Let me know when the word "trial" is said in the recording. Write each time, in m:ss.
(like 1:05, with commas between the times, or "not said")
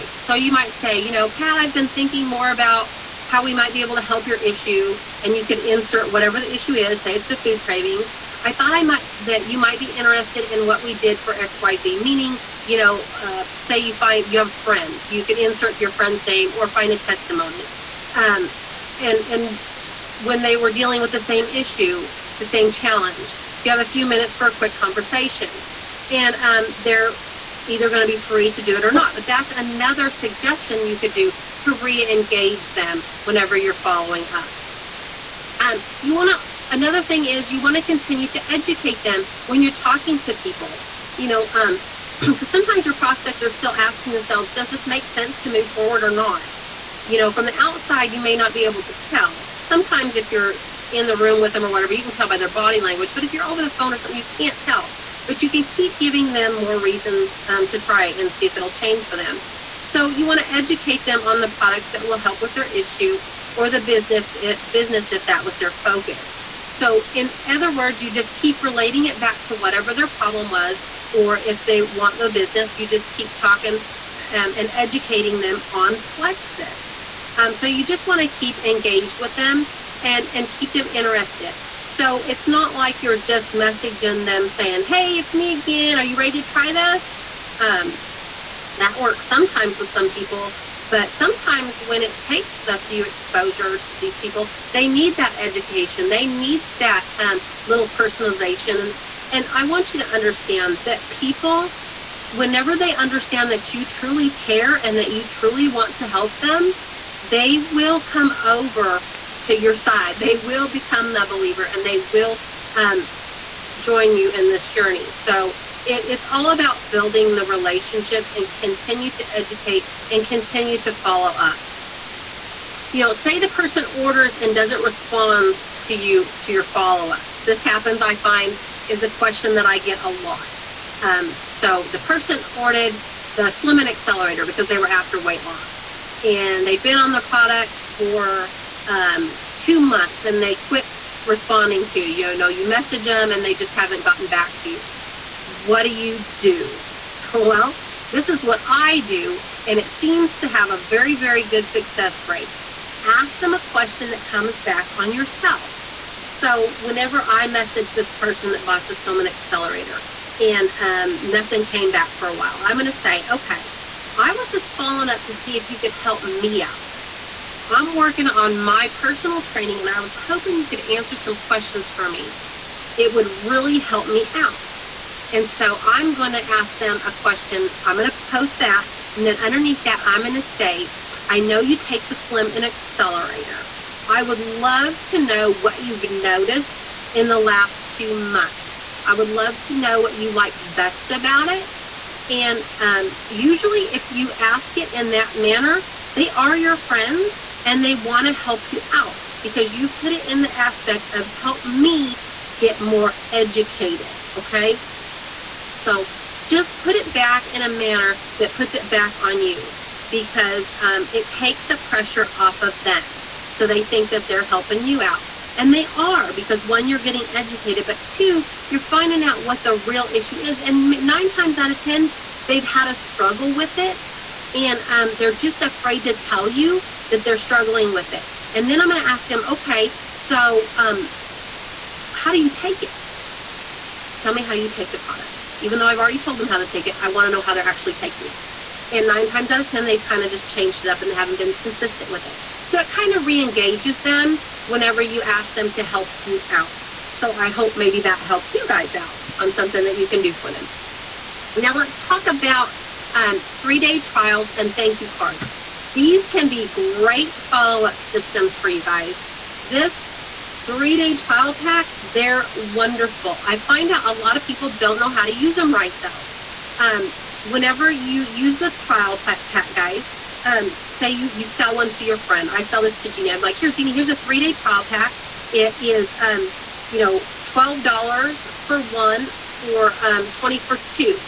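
4:14, 4:21, 4:28, 4:34.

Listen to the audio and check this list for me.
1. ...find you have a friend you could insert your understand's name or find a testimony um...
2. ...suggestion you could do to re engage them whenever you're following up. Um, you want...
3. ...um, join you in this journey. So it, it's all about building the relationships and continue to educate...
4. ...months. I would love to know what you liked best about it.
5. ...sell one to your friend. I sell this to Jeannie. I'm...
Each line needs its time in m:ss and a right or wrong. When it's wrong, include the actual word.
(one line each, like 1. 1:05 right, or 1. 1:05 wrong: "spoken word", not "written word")
1. 0:13 wrong: "friend", not "understand"
2. 0:30 right
3. 1:52 right
4. 3:08 right
5. 4:31 right.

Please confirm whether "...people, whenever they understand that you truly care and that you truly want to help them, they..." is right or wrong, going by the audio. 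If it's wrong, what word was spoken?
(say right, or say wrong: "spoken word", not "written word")
right.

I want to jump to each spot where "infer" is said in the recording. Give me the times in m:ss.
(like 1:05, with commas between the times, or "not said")
not said.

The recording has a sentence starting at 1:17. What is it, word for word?
Um, so you just want to keep engaged with them and and keep them interested.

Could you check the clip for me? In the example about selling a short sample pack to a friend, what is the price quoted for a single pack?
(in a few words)
$12.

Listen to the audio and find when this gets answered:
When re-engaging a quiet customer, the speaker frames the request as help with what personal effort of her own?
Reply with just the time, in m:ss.
2:48.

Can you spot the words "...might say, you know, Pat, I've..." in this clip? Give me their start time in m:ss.
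0:00.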